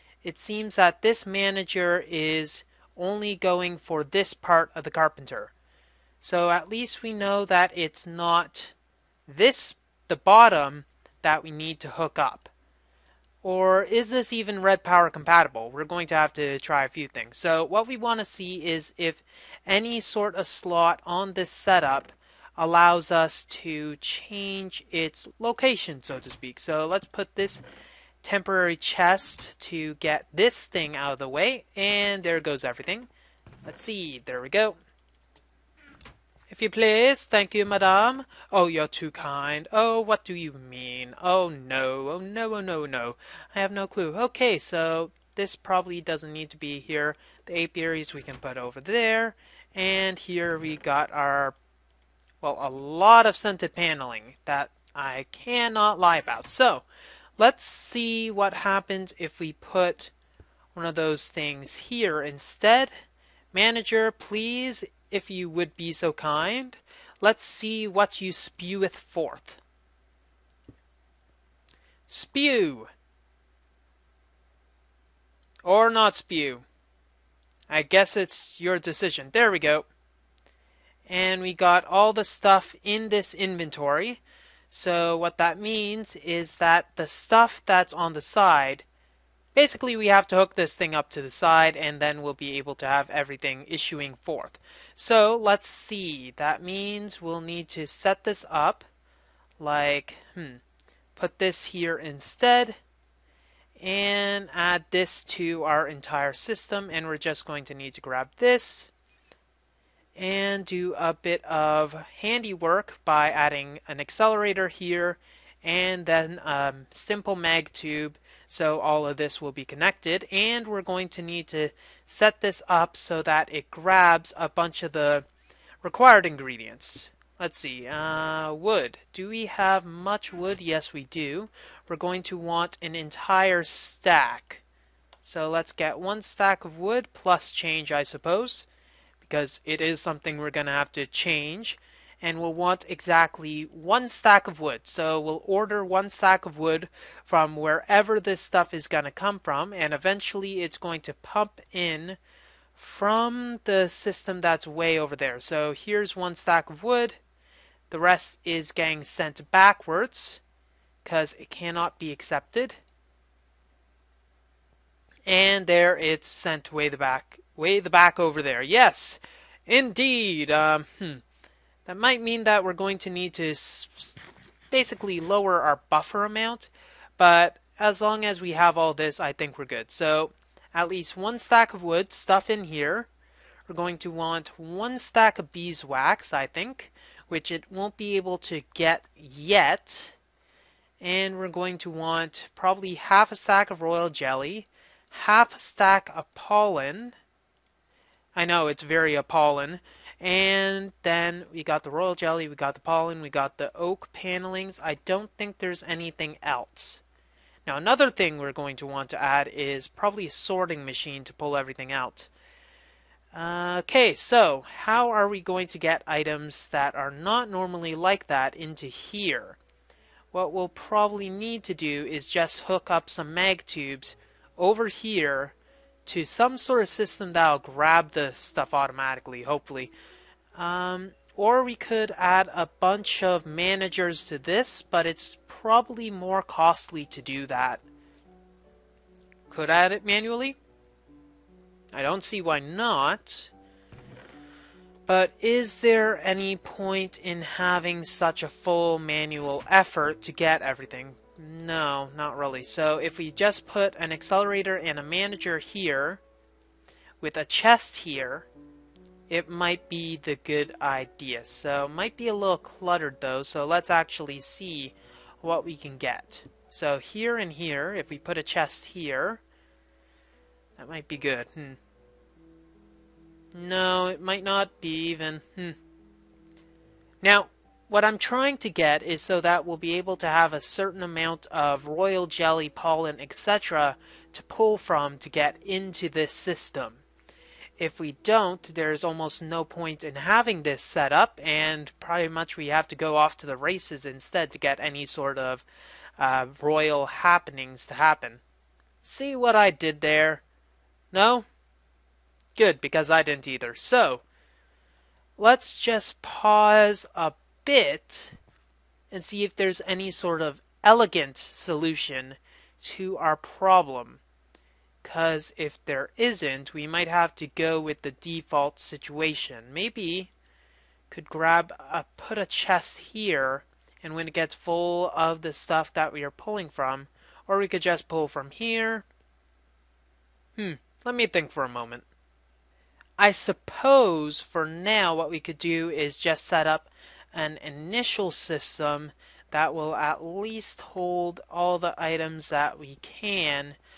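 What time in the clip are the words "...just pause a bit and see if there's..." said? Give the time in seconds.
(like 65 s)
305 s.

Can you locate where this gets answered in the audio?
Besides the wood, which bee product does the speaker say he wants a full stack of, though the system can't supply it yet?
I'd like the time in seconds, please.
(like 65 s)
185 s.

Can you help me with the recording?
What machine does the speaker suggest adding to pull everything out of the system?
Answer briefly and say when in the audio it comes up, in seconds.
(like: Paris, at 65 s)
sorting machine, at 210 s.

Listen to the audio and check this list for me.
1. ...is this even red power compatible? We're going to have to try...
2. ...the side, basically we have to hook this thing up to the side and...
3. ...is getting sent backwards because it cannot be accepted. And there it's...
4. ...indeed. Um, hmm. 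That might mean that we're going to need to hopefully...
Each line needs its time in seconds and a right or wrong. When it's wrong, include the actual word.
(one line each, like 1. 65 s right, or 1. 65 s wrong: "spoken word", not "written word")
1. 13 s right
2. 88 s right
3. 158 s right
4. 169 s wrong: "basically", not "hopefully".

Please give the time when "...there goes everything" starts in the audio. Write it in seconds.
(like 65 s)
32 s.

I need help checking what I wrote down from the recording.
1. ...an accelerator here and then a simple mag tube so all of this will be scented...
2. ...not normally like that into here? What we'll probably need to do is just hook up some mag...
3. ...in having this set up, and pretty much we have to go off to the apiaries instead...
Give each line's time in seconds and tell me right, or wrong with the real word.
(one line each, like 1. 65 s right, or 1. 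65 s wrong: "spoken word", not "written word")
1. 113 s wrong: "connected", not "scented"
2. 217 s right
3. 290 s wrong: "races", not "apiaries".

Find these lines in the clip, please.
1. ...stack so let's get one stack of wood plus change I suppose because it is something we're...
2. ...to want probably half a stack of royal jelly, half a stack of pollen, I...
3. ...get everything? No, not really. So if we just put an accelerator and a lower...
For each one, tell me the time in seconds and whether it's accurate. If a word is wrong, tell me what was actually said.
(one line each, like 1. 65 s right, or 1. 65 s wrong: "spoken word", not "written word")
1. 133 s right
2. 191 s right
3. 250 s wrong: "manager", not "lower".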